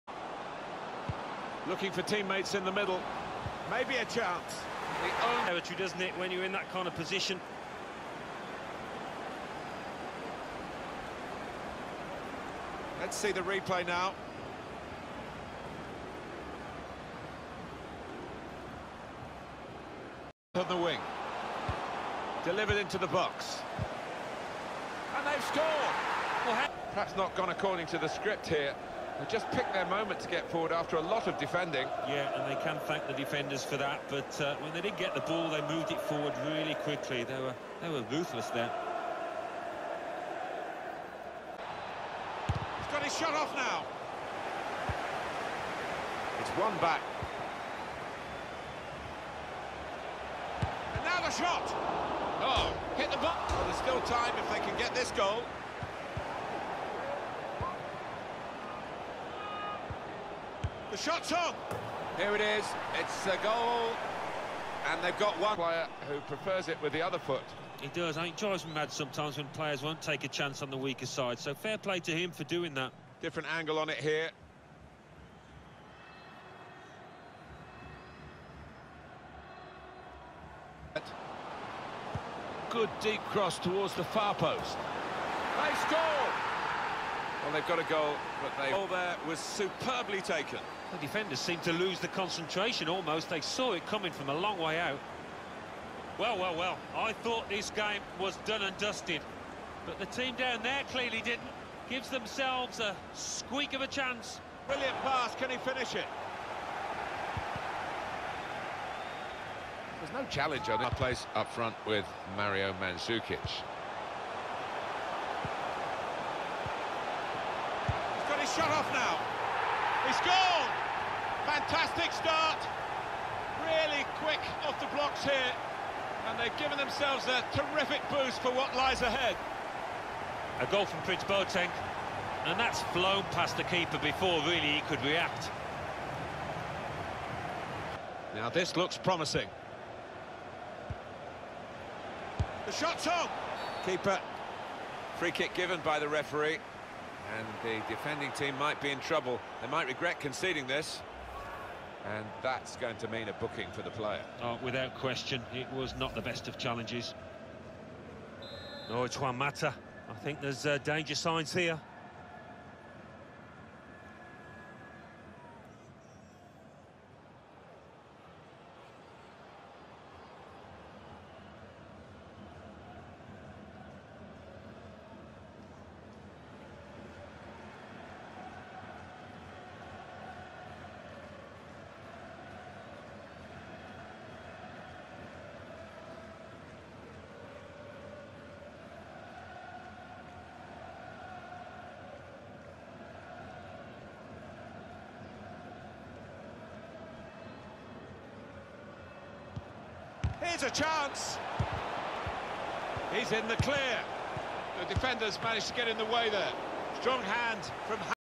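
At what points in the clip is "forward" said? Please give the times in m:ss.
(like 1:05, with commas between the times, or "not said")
0:30, 0:36.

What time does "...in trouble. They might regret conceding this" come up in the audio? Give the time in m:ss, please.
2:28.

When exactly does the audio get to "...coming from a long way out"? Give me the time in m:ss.
1:33.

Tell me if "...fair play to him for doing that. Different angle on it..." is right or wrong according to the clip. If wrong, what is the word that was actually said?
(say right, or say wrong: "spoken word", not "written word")
right.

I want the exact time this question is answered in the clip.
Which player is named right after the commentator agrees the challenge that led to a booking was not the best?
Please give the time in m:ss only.
2:39.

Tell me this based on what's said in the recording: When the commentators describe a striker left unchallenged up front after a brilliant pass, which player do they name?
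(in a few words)
Mario Mandzukic.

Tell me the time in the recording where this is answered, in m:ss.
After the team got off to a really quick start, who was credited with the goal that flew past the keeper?
2:11.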